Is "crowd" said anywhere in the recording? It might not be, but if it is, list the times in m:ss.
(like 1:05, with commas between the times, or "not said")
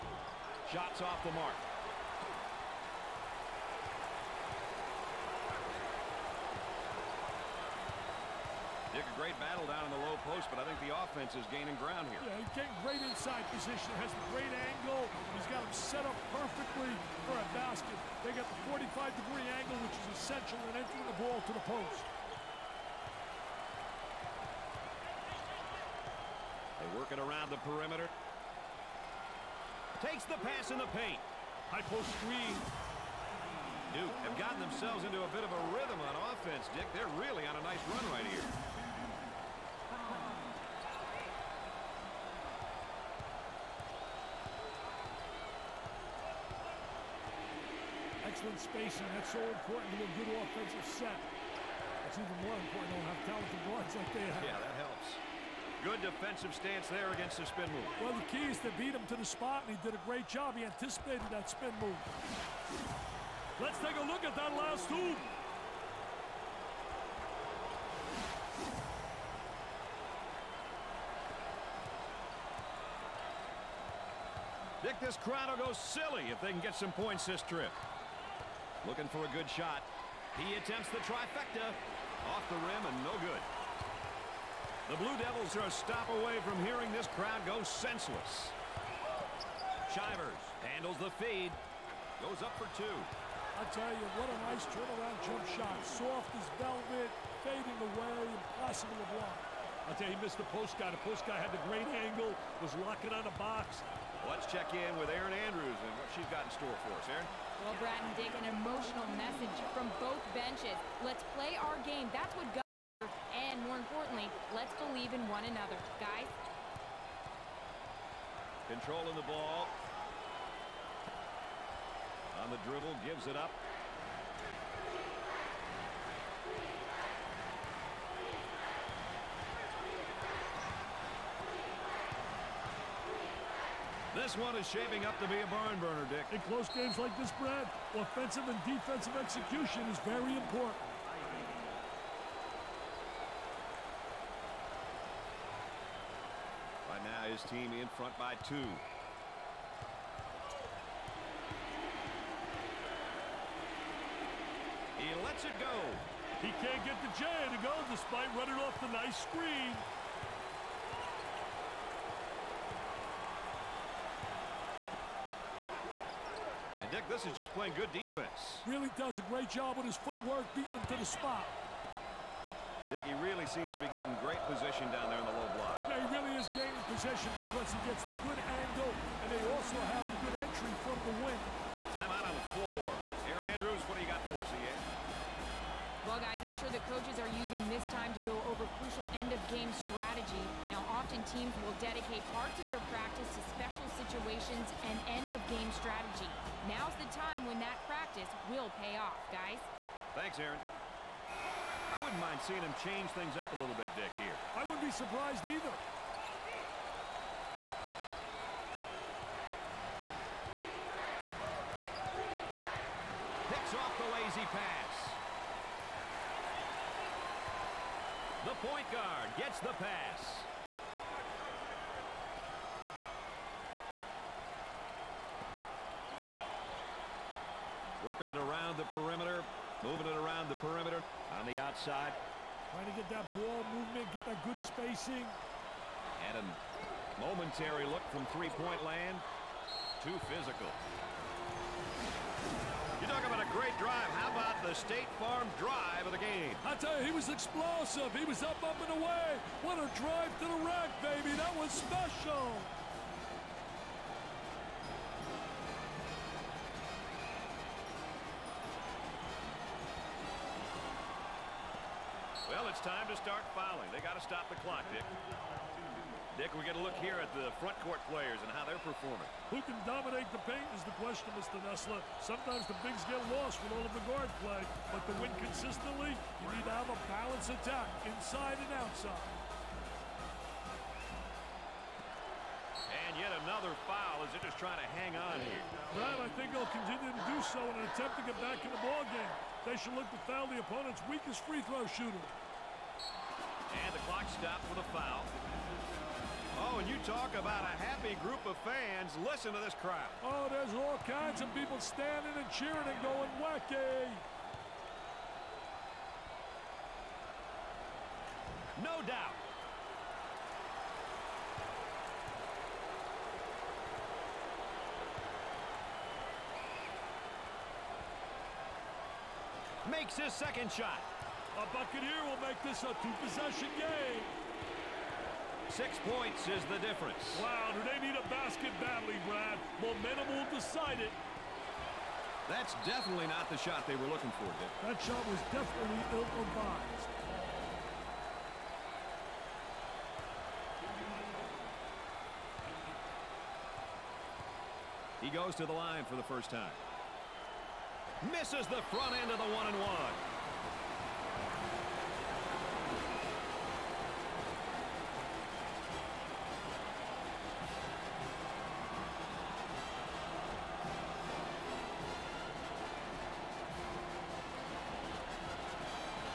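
1:15, 1:27, 4:59.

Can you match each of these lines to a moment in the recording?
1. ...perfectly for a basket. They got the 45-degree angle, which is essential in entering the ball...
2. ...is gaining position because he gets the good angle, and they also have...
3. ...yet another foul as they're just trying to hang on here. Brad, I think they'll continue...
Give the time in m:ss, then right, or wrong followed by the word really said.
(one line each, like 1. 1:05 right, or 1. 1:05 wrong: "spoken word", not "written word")
1. 0:16 right
2. 2:56 right
3. 4:43 right.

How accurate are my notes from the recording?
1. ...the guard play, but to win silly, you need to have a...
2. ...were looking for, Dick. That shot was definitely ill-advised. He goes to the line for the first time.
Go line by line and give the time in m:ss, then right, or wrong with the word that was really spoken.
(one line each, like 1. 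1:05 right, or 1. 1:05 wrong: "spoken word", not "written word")
1. 4:33 wrong: "consistently", not "silly"
2. 5:33 right.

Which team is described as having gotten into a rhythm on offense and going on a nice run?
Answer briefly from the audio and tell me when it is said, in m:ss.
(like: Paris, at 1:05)
Duke, at 0:33.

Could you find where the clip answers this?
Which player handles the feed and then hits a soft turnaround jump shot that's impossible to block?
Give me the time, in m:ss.
1:29.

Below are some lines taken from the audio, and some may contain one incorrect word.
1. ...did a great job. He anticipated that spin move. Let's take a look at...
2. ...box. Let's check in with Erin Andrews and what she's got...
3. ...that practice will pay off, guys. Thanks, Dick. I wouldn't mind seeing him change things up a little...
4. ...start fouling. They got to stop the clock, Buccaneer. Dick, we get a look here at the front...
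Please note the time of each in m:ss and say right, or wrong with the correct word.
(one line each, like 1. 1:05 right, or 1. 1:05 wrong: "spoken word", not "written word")
1. 0:59 right
2. 1:43 right
3. 3:17 wrong: "Erin", not "Dick"
4. 4:23 wrong: "Dick", not "Buccaneer".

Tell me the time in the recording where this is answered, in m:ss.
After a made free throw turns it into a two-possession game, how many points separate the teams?
5:25.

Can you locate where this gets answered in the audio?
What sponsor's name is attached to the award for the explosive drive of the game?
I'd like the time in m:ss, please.
4:04.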